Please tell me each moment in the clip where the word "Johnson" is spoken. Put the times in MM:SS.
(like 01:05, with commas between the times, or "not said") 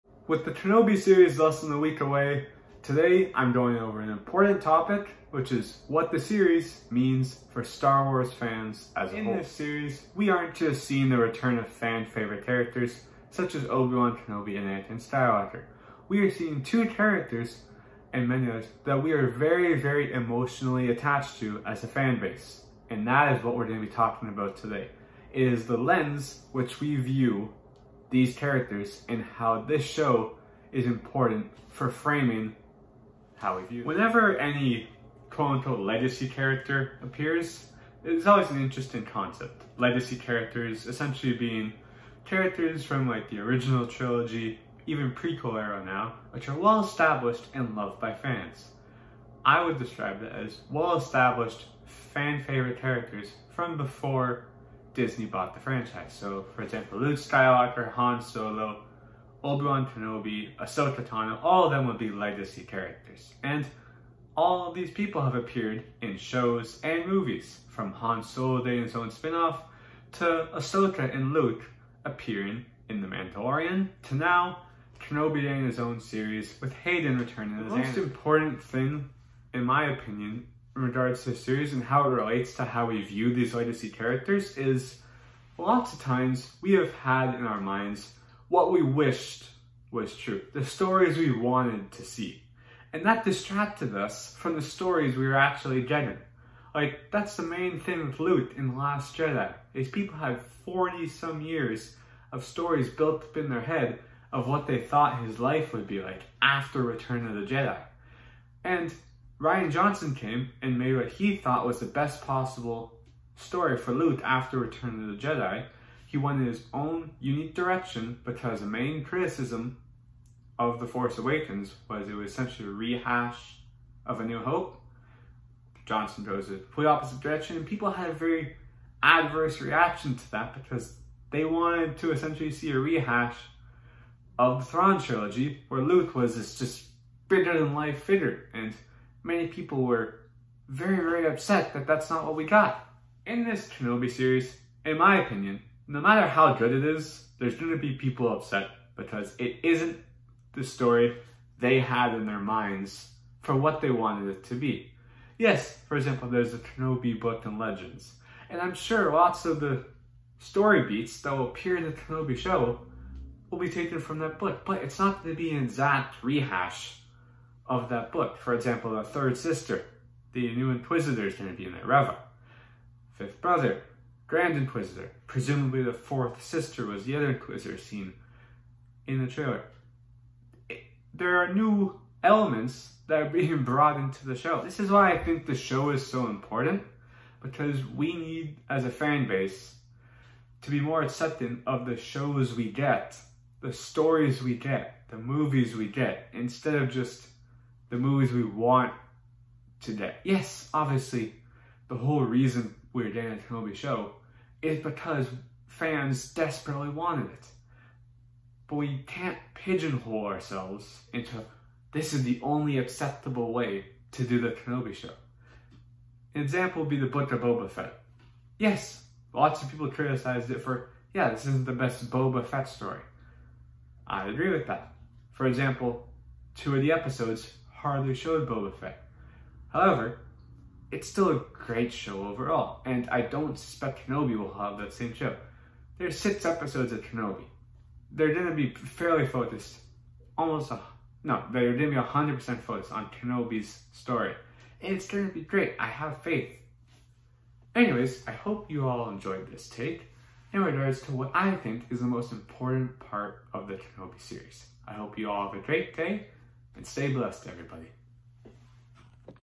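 01:49, 02:05.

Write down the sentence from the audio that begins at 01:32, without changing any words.
And that distracted us from the stories we were actually getting.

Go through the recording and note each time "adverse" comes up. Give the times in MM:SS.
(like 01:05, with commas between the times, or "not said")
02:09.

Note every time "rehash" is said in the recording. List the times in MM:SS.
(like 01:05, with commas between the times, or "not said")
02:02, 02:12, 02:46.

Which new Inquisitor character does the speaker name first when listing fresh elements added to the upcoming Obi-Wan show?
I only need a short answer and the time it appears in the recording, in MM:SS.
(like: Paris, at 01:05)
the Third Sister, at 02:49.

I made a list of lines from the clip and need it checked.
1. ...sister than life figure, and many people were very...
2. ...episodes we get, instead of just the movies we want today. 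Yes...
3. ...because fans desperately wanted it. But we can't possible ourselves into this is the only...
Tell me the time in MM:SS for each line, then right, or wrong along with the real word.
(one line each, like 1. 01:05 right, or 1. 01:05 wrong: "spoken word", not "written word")
1. 02:17 wrong: "bigger", not "sister"
2. 03:15 wrong: "movies", not "episodes"
3. 03:24 wrong: "pigeonhole", not "possible".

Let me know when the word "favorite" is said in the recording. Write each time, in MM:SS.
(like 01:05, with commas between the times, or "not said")
00:12, 00:52.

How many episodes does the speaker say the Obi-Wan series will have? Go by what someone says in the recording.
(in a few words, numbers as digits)
6.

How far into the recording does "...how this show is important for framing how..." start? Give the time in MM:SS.
00:29.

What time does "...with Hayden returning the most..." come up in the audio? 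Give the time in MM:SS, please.
01:16.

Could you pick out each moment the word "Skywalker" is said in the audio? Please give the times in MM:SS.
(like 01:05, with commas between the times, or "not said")
00:15, 00:57.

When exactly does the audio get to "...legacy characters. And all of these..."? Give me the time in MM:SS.
01:02.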